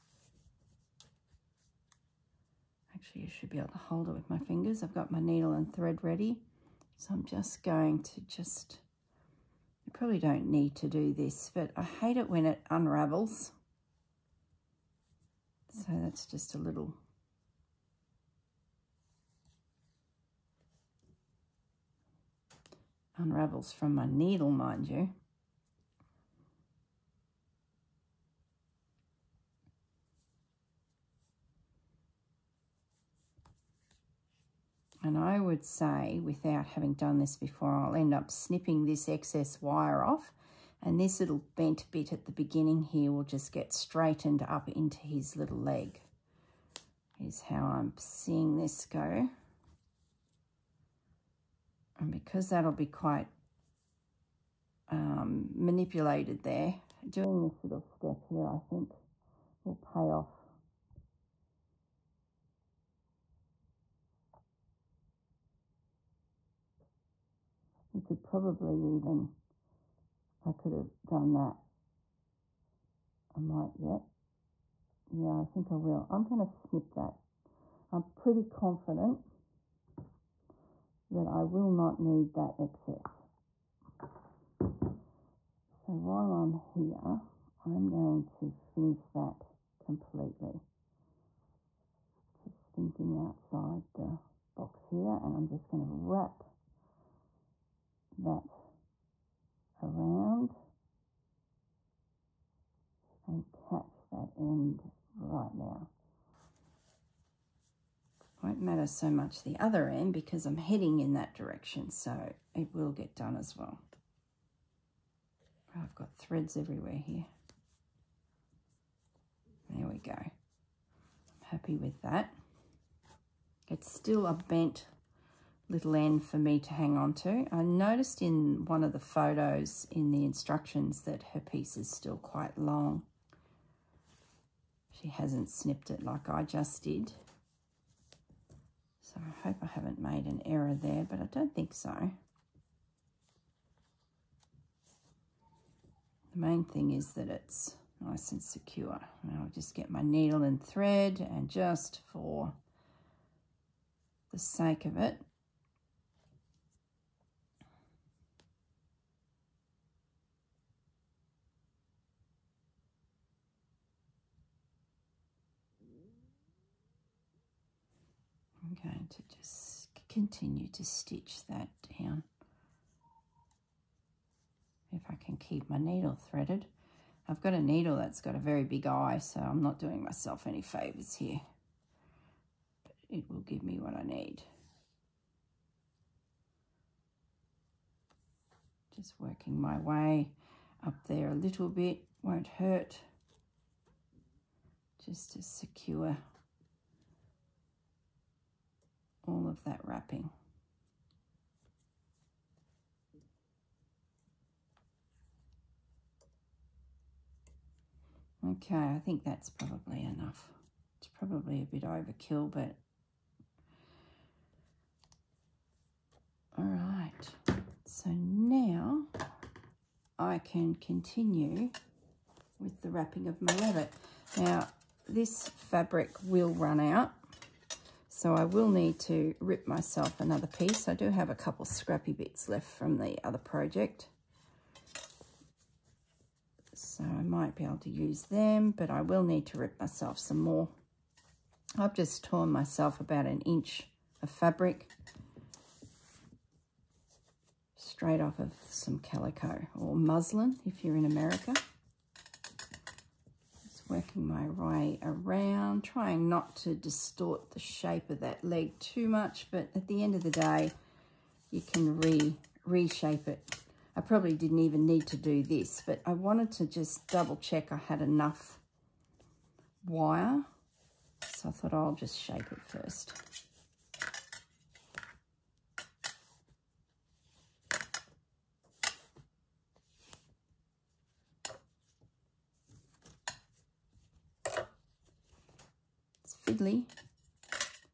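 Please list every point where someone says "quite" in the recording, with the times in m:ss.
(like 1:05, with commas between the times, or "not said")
0:52, 2:12.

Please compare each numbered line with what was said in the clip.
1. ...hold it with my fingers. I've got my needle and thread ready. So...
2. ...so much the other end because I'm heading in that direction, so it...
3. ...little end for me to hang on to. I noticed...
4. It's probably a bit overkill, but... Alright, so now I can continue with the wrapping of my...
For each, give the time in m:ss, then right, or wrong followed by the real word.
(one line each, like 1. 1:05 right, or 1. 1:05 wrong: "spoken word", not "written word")
1. 0:03 right
2. 1:48 right
3. 2:05 right
4. 3:30 right.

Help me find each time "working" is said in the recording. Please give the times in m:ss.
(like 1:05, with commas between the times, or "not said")
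3:09, 4:13.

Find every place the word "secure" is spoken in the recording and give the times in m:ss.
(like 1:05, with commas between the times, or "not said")
2:28, 3:15.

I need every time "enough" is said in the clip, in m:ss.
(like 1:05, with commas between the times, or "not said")
3:30, 4:28.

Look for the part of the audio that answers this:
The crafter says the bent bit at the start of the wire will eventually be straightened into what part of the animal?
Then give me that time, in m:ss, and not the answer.
0:44.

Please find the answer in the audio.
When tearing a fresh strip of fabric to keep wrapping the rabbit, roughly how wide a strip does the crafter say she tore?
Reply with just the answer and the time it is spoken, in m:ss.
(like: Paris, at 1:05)
about an inch, at 4:03.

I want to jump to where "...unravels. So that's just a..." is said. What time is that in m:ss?
0:12.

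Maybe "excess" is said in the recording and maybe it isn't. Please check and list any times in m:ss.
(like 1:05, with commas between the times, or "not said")
0:39, 1:22.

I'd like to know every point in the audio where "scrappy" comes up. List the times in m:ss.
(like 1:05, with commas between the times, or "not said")
3:51.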